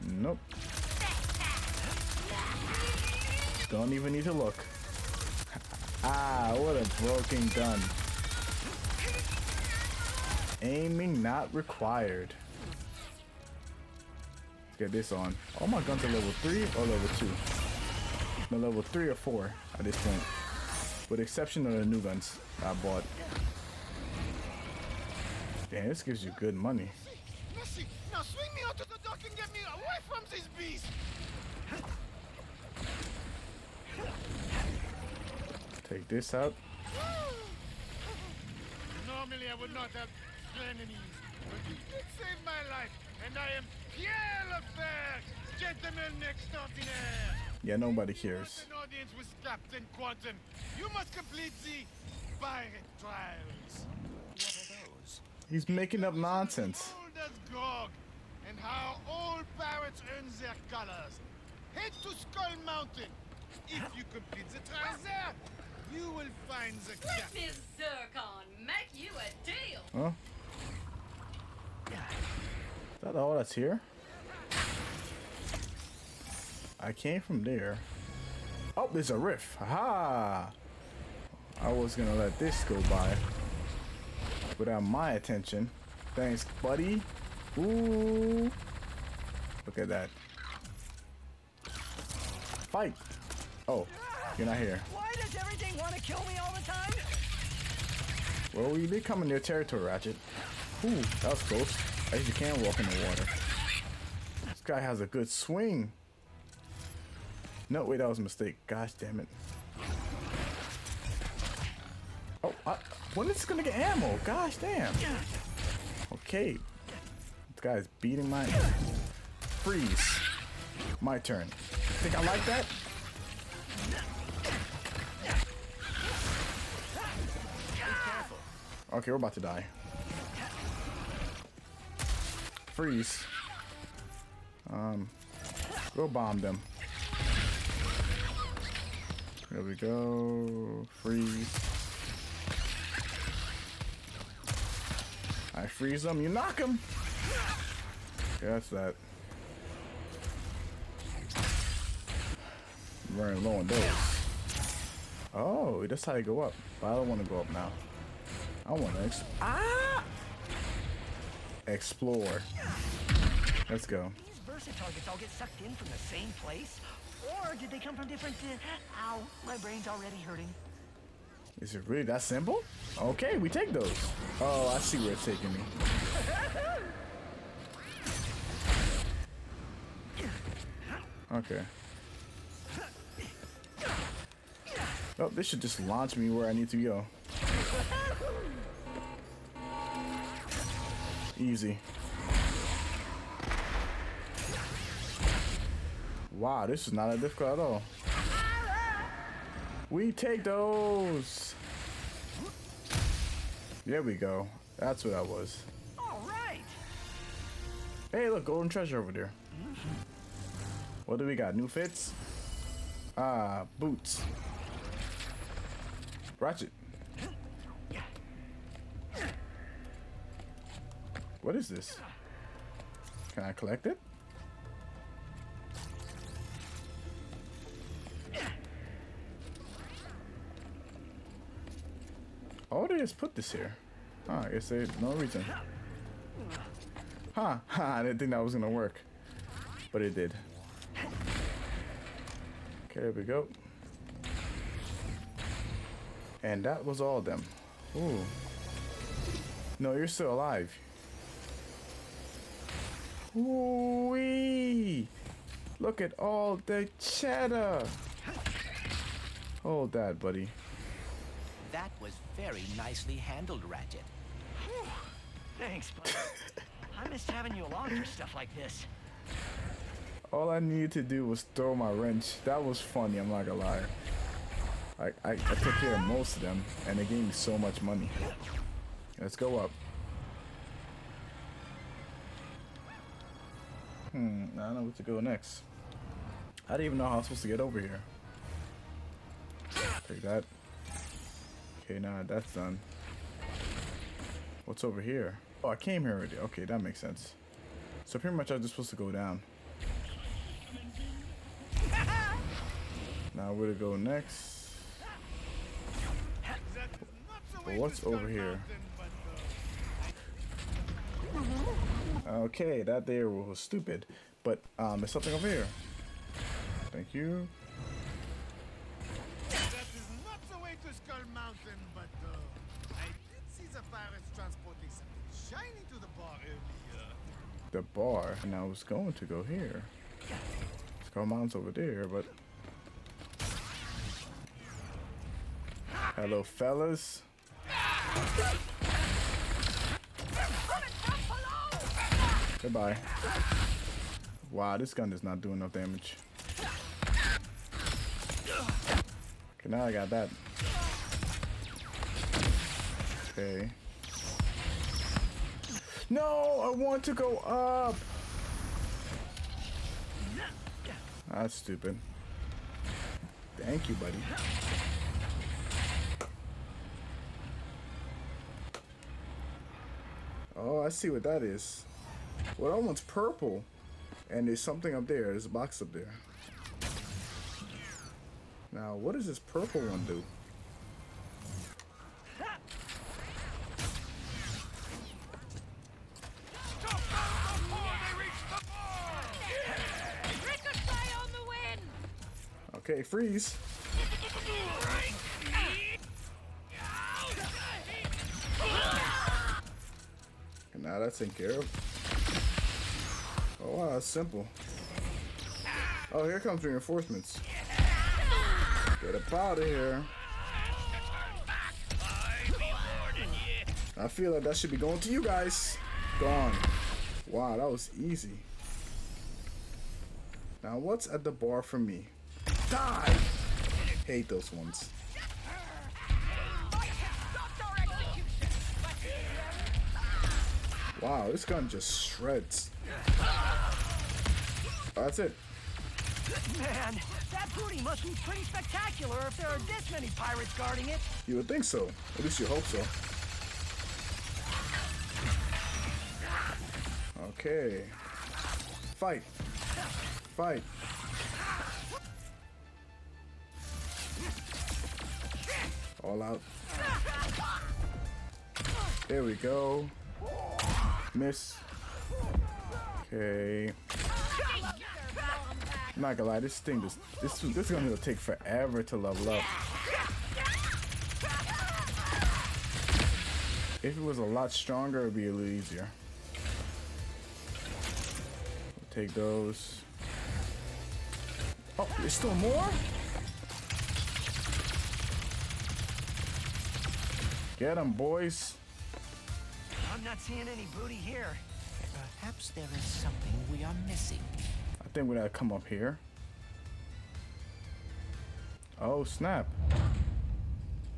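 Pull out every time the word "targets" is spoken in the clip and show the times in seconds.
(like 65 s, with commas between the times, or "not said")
164 s.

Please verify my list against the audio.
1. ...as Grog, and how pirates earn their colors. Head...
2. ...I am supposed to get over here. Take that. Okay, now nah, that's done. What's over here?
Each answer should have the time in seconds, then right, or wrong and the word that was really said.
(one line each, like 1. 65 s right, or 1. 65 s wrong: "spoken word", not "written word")
1. 57 s right
2. 287 s right.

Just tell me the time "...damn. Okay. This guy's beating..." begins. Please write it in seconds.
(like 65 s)
114 s.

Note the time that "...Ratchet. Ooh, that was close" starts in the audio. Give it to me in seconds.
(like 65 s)
99 s.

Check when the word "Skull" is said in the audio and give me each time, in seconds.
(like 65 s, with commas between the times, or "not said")
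62 s, 320 s, 331 s.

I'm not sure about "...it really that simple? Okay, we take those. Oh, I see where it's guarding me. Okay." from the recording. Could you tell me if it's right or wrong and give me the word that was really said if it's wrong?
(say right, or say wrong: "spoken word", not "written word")
wrong: "taking", not "guarding".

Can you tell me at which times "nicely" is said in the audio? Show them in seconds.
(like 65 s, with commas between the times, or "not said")
262 s.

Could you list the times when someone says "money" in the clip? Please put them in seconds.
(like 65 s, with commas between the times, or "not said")
26 s, 277 s.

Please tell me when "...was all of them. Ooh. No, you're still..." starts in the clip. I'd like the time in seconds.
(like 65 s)
246 s.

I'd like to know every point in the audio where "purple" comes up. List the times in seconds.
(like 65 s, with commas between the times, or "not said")
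373 s, 379 s.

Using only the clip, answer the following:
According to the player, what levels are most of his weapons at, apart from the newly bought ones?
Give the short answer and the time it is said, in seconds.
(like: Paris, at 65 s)
Level 3 or 4, at 18 s.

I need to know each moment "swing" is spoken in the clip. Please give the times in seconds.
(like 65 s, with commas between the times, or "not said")
28 s, 105 s.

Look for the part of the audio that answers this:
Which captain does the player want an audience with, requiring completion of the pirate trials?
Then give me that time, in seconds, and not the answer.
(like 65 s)
49 s.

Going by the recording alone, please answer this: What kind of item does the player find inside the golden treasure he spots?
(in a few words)
Boots.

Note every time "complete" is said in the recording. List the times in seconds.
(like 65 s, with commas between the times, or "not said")
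51 s, 64 s.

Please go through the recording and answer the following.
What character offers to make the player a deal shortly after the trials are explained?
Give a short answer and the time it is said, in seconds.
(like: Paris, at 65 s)
Zurkon, at 67 s.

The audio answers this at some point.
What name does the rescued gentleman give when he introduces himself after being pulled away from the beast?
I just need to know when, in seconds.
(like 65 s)
43 s.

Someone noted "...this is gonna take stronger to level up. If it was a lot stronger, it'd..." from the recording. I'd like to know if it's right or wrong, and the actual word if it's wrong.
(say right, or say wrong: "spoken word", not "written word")
wrong: "forever", not "stronger".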